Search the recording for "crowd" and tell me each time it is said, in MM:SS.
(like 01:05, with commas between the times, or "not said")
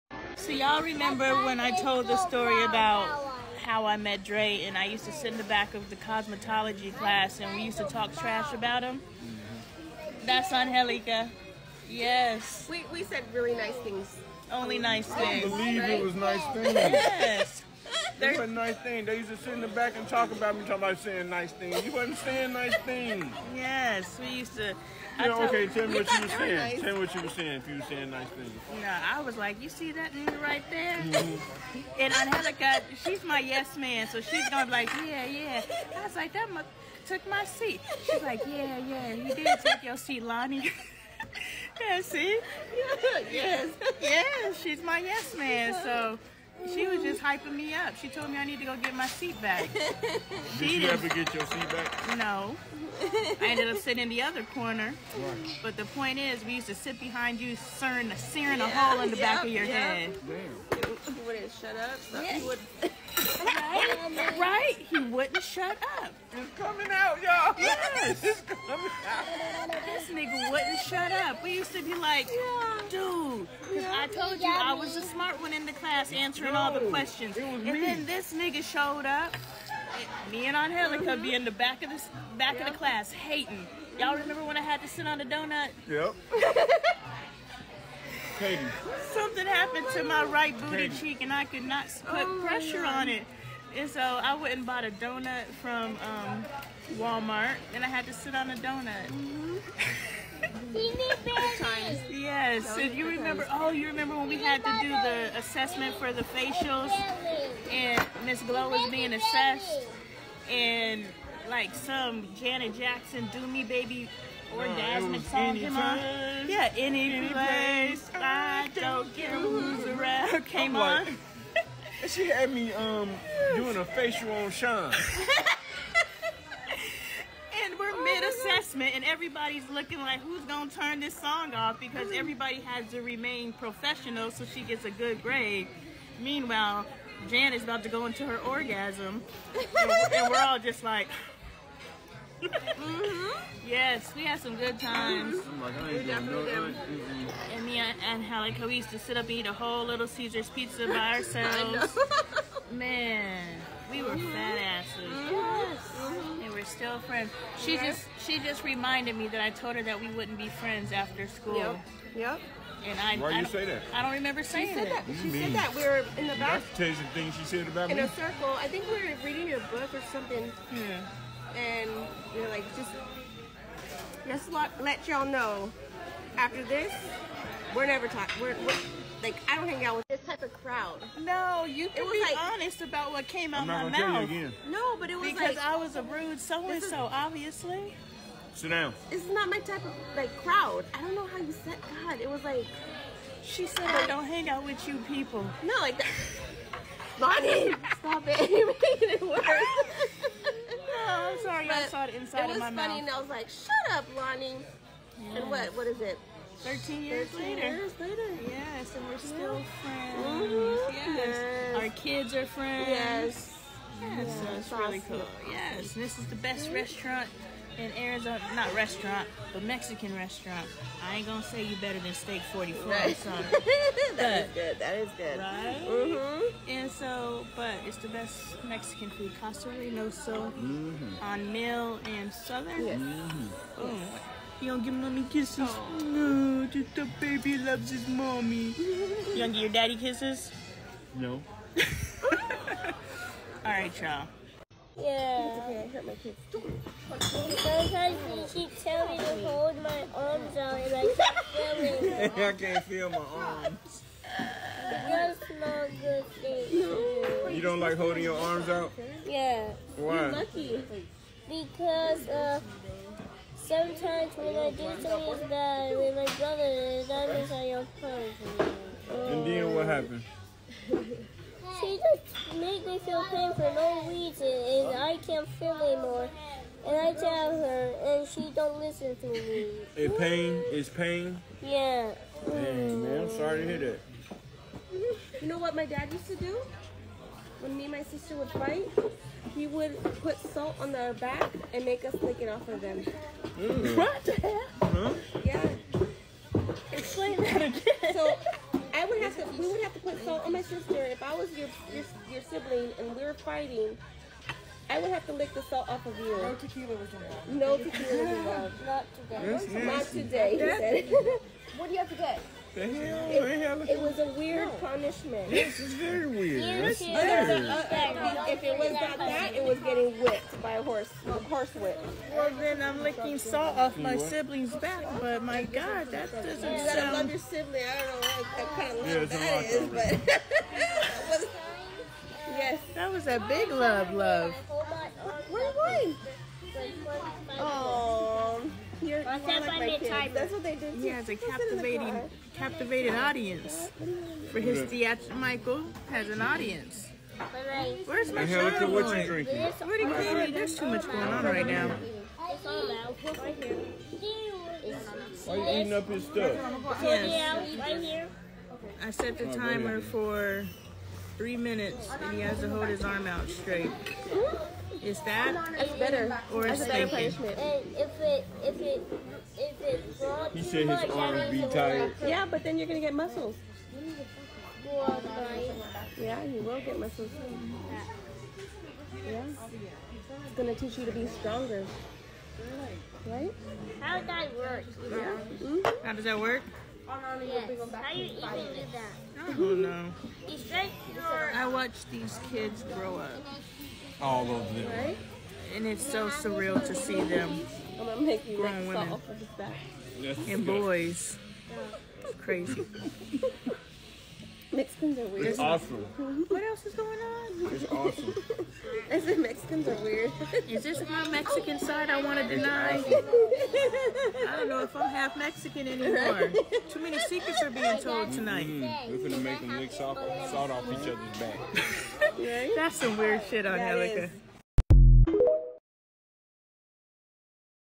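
03:00, 03:10.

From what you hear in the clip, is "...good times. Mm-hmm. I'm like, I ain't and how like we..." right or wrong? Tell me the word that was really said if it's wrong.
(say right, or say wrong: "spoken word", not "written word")
right.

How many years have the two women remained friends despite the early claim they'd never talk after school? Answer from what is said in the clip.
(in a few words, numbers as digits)
13.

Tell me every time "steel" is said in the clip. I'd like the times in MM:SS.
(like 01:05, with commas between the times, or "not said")
not said.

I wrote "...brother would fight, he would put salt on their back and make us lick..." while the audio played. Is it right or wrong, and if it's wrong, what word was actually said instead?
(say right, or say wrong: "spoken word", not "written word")
wrong: "sister", not "brother".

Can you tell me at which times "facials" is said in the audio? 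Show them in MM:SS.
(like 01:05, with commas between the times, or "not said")
01:46, 02:03.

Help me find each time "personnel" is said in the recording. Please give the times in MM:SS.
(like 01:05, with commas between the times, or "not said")
not said.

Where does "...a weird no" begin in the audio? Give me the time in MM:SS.
05:14.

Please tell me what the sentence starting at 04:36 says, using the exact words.
And I tell her, and she don't listen to me.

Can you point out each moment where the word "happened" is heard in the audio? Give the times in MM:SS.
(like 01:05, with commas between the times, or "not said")
01:29, 04:29.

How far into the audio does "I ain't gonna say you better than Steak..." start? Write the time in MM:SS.
03:41.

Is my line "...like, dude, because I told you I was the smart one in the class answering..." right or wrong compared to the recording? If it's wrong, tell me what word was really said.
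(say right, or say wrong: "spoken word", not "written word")
right.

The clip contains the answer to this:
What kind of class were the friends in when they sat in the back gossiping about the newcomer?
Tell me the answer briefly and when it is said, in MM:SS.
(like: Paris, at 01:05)
Cosmetology, at 00:05.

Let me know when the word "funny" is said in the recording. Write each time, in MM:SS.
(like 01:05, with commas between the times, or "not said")
03:22.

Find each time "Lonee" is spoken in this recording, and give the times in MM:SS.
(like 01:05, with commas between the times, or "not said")
00:40, 03:17, 03:24.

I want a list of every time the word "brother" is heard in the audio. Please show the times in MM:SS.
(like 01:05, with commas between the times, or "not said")
04:26.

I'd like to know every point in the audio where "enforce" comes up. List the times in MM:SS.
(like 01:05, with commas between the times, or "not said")
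not said.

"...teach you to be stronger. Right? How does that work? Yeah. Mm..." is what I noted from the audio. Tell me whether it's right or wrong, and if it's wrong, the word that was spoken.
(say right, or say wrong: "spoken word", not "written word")
right.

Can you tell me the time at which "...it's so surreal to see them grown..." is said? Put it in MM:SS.
06:35.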